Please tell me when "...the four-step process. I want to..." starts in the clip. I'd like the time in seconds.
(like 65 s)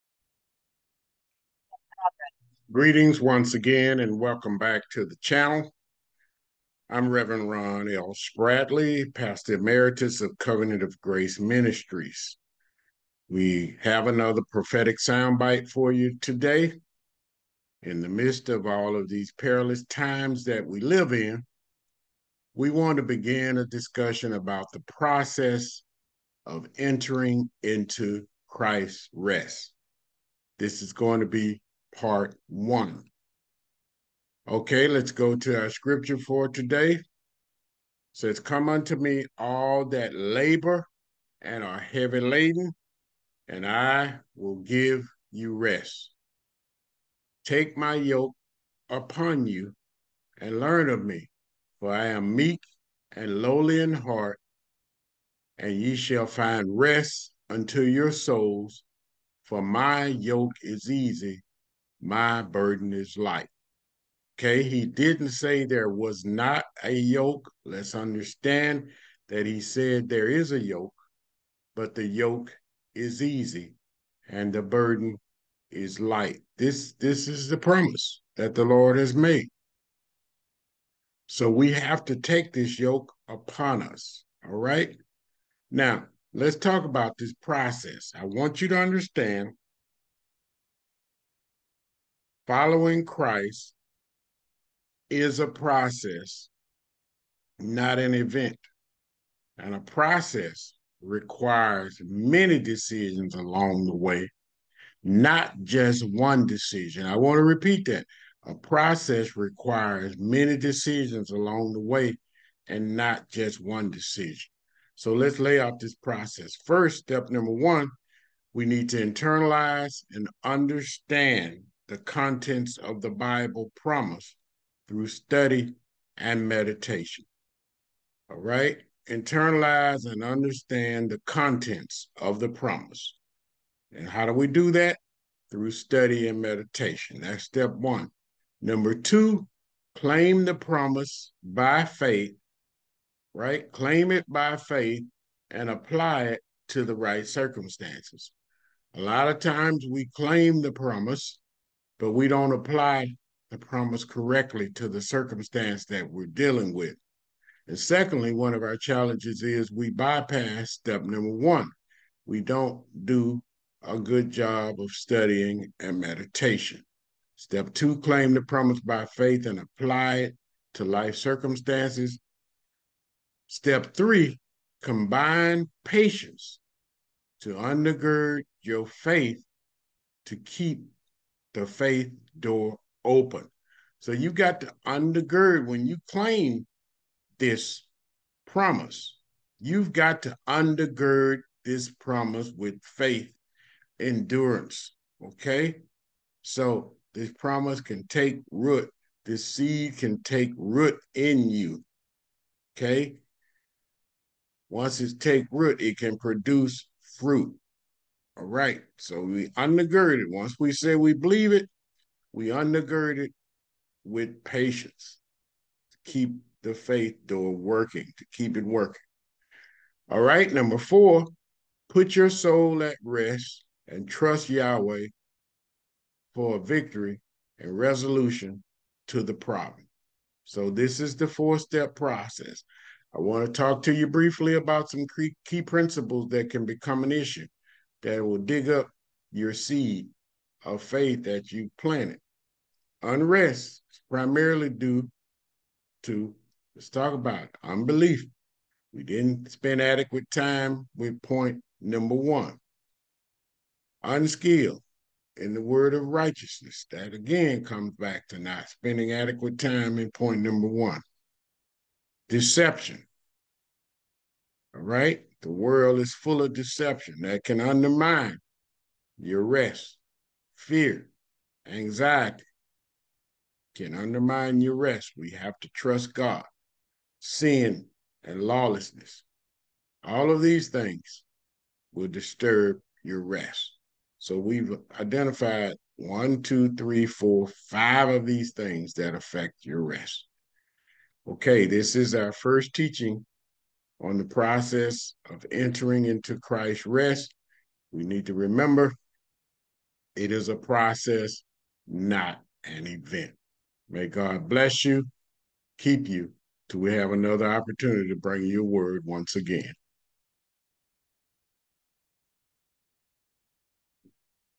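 231 s.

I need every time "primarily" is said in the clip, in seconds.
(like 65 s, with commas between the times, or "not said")
244 s.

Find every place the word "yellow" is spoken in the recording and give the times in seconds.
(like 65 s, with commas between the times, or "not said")
not said.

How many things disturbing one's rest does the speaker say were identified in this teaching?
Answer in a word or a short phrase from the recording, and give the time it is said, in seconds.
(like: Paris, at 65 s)
5, at 287 s.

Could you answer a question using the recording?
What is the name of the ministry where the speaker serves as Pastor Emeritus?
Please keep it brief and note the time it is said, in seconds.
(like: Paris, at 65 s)
Covenant of Grace Ministries, at 10 s.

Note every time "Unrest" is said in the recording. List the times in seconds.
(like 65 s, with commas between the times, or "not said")
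243 s.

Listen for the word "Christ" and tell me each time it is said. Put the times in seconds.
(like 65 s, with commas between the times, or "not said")
28 s, 93 s, 296 s.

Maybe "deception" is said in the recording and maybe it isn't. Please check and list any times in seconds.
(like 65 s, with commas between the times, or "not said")
262 s, 266 s.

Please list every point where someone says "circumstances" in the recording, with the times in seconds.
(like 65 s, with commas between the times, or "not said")
147 s, 155 s, 171 s.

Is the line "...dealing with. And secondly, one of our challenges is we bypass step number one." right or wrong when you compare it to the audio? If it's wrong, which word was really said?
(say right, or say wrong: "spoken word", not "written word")
right.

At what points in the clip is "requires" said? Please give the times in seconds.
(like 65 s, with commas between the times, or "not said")
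101 s, 109 s.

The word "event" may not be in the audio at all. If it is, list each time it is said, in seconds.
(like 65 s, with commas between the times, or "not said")
98 s, 302 s.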